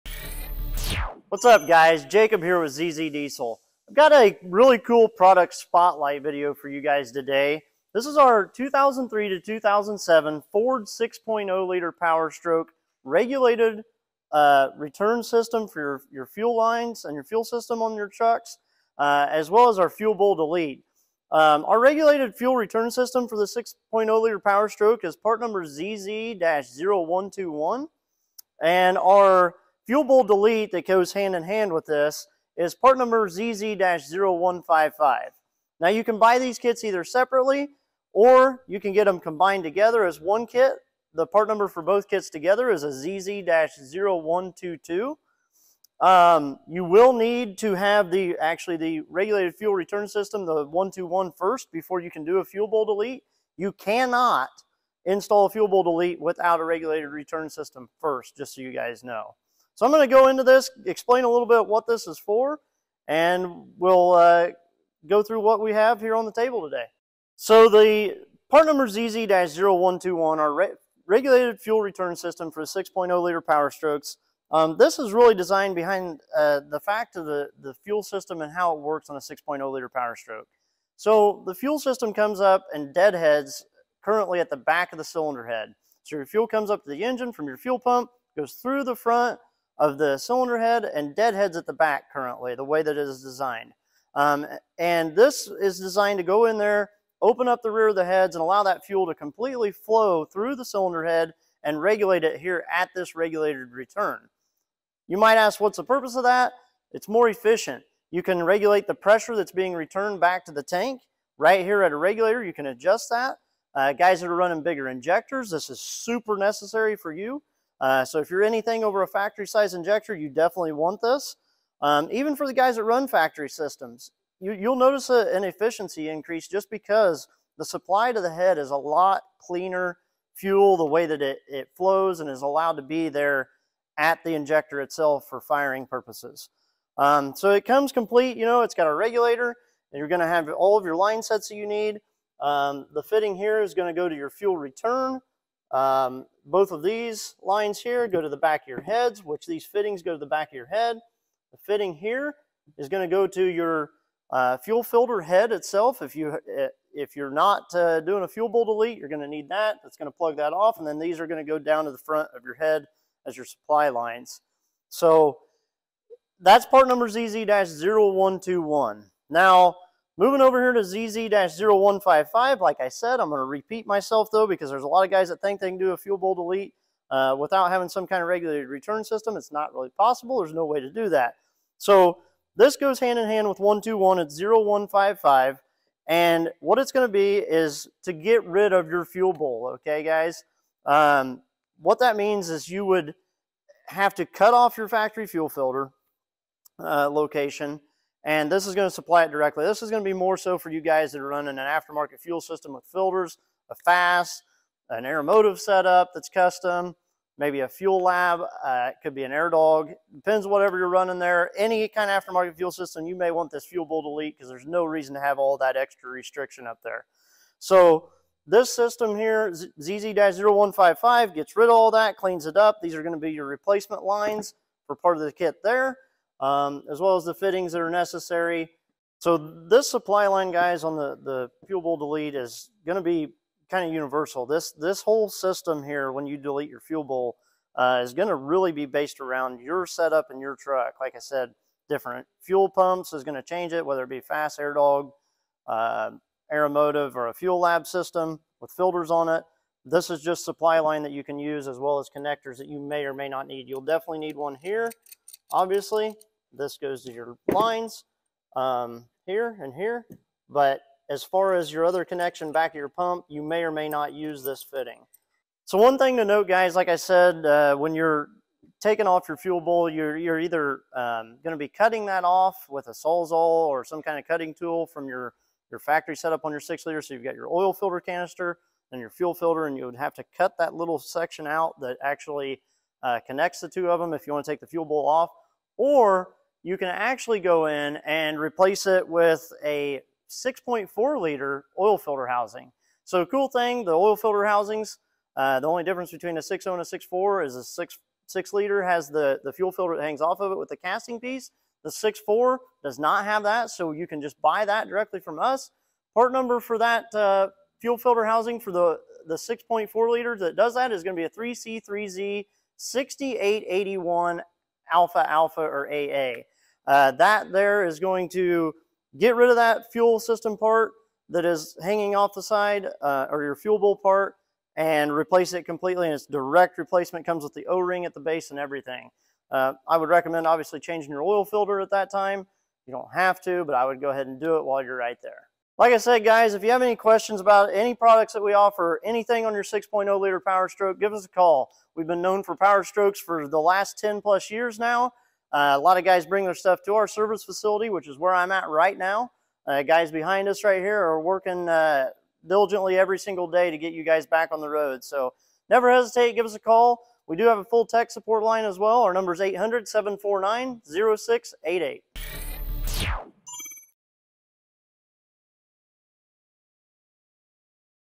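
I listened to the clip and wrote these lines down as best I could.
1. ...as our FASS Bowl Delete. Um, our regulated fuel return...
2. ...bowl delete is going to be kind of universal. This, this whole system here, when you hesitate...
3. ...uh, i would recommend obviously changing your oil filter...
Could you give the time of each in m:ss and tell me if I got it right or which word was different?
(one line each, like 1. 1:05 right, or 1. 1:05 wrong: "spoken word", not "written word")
1. 0:19 wrong: "Fuel", not "FASS"
2. 3:51 wrong: "delete", not "hesitate"
3. 5:29 right.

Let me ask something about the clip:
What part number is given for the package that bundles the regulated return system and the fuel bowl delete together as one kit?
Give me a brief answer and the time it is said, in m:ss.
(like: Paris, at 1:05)
ZZ-0122, at 0:42.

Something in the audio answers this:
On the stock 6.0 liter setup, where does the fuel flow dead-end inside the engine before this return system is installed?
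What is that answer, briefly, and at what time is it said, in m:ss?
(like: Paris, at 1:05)
back of the cylinder head, at 1:24.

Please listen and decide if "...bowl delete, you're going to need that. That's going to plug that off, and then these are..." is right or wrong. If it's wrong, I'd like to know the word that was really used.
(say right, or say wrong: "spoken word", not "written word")
right.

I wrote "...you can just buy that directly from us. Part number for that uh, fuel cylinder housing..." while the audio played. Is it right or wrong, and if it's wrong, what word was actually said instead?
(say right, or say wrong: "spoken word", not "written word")
wrong: "filter", not "cylinder".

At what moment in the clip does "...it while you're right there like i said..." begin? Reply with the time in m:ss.
5:34.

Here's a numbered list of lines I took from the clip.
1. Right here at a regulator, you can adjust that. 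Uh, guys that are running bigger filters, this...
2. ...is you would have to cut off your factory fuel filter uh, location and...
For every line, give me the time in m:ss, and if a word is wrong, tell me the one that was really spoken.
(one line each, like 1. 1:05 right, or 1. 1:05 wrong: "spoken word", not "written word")
1. 1:51 wrong: "injectors", not "filters"
2. 3:12 right.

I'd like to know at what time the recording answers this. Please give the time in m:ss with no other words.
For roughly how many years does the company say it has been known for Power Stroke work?
5:43.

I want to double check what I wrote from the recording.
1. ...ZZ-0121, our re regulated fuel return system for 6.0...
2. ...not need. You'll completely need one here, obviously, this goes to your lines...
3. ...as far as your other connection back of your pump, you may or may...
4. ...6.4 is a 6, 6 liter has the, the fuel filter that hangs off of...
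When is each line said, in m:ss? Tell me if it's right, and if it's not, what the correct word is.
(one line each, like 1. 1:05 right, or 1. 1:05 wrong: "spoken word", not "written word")
1. 1:08 right
2. 4:13 wrong: "definitely", not "completely"
3. 4:21 right
4. 4:56 right.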